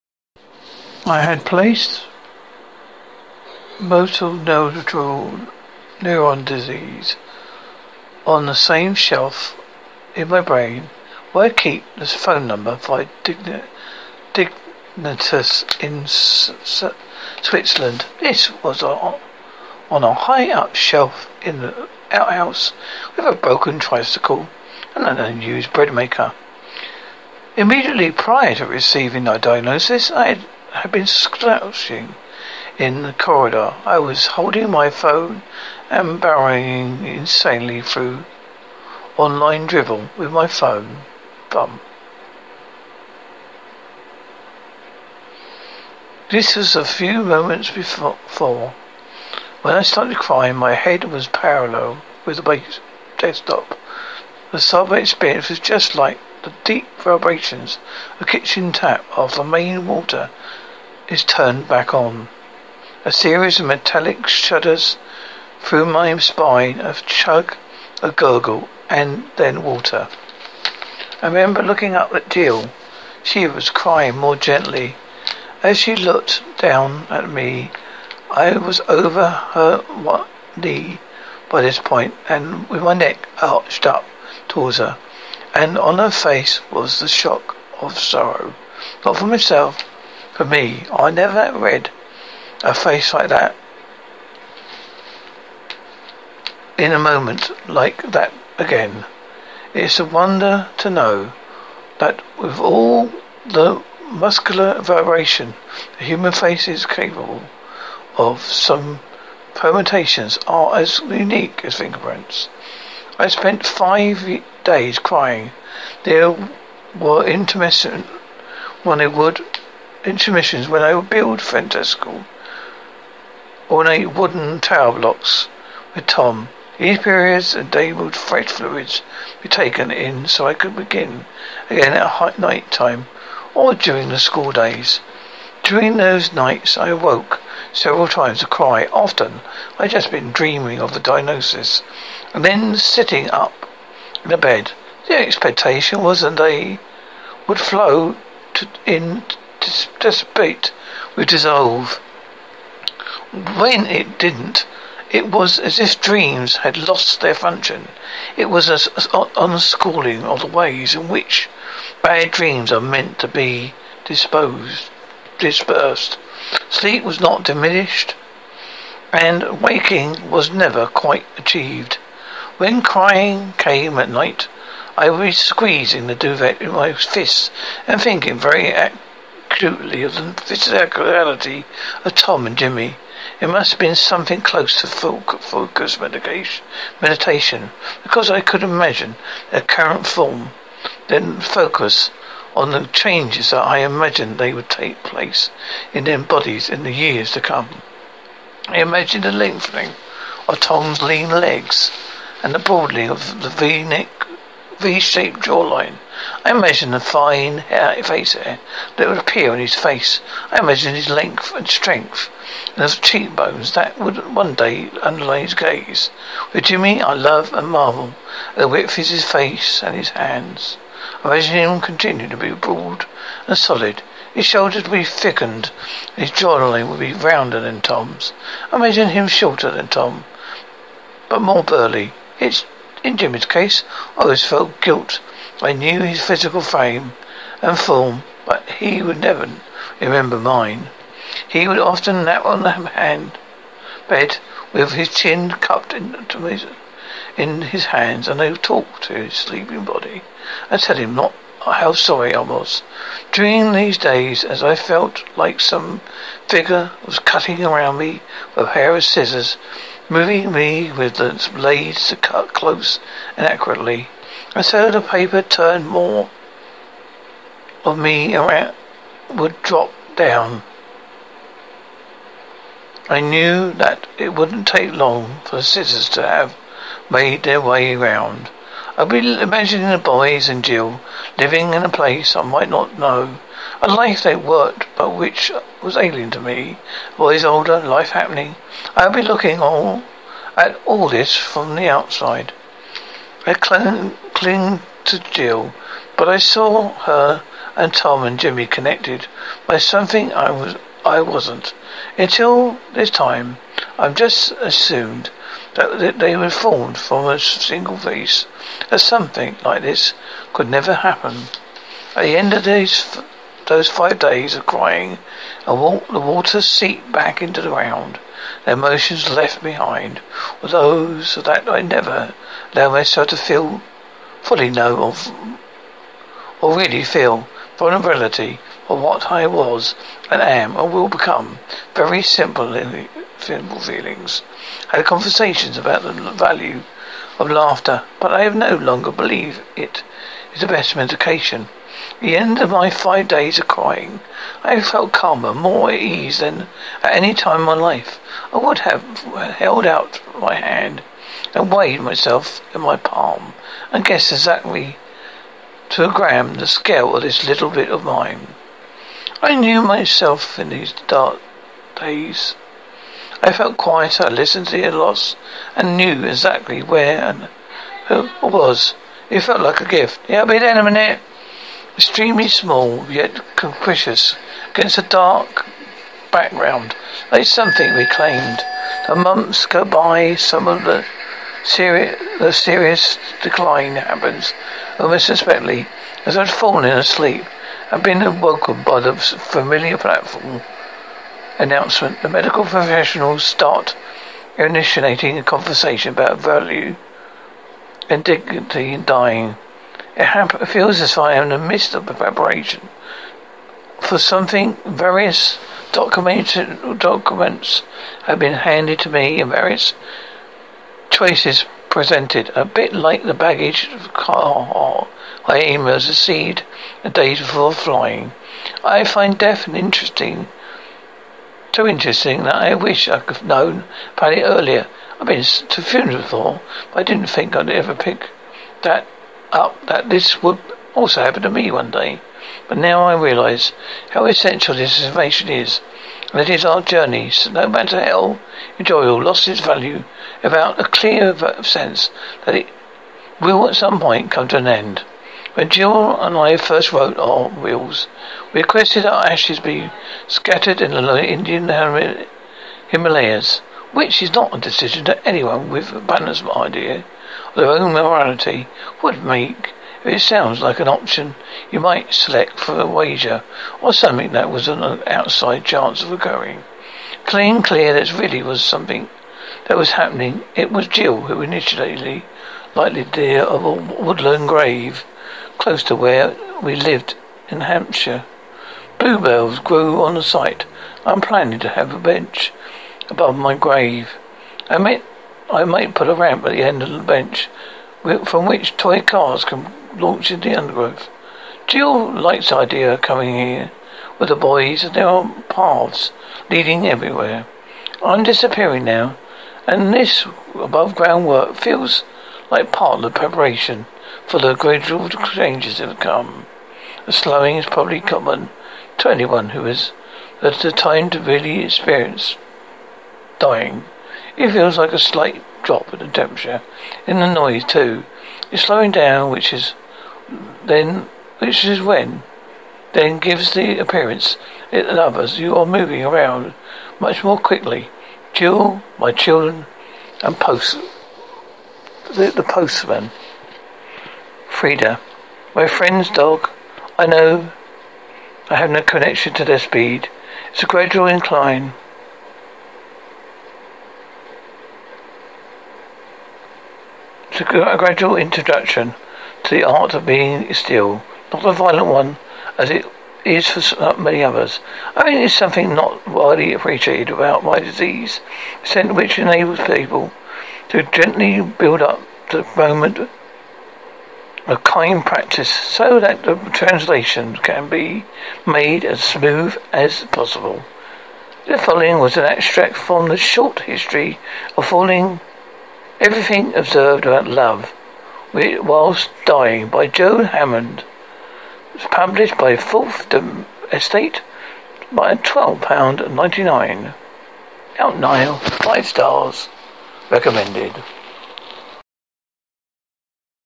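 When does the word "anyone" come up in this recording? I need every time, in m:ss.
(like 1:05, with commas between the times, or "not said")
7:35, 8:29.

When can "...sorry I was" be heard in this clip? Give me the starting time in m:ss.
4:11.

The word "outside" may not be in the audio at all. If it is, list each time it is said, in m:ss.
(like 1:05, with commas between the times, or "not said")
4:51, 7:45.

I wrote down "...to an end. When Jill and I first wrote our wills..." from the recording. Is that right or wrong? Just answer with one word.
right.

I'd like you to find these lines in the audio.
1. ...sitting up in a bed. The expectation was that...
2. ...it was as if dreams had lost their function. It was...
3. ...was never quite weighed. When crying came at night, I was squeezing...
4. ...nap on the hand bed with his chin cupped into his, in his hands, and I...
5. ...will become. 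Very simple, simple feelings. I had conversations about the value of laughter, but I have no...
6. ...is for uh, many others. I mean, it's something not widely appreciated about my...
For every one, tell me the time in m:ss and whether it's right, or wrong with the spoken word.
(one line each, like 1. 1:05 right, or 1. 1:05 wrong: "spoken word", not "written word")
1. 2:22 right
2. 2:35 right
3. 2:50 wrong: "achieved", not "weighed"
4. 4:02 right
5. 5:30 right
6. 9:13 right.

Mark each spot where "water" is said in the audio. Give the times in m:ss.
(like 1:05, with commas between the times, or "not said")
0:59, 1:09, 5:16.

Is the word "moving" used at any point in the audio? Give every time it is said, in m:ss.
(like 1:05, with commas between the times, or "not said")
4:20, 8:45.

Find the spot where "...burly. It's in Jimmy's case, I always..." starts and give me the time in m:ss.
3:51.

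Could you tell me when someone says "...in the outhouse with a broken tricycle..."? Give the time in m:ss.
0:21.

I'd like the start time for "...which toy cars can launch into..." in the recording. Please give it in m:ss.
8:08.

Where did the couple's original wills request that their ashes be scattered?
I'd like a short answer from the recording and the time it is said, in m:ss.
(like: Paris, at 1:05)
Indian Himalayas, at 7:31.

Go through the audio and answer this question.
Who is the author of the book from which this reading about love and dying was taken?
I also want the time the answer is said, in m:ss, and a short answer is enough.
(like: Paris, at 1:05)
Joe Hammond, at 9:39.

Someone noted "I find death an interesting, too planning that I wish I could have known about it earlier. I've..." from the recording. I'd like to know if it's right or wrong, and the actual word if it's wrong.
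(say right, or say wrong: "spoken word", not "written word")
wrong: "interesting", not "planning".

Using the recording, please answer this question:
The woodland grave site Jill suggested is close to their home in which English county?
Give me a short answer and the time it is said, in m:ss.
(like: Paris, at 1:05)
Hampshire, at 7:57.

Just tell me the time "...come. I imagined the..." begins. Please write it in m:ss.
3:17.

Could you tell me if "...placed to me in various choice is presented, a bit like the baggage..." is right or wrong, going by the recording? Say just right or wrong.
wrong.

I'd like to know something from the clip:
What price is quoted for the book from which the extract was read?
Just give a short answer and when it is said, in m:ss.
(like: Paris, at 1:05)
£12.99, at 9:45.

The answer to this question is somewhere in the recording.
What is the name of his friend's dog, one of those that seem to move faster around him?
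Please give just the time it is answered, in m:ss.
8:54.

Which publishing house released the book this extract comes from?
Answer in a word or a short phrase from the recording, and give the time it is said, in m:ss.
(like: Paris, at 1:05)
Fourth Estate, at 9:42.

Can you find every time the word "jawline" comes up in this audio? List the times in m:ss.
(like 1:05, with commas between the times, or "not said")
3:25, 3:46.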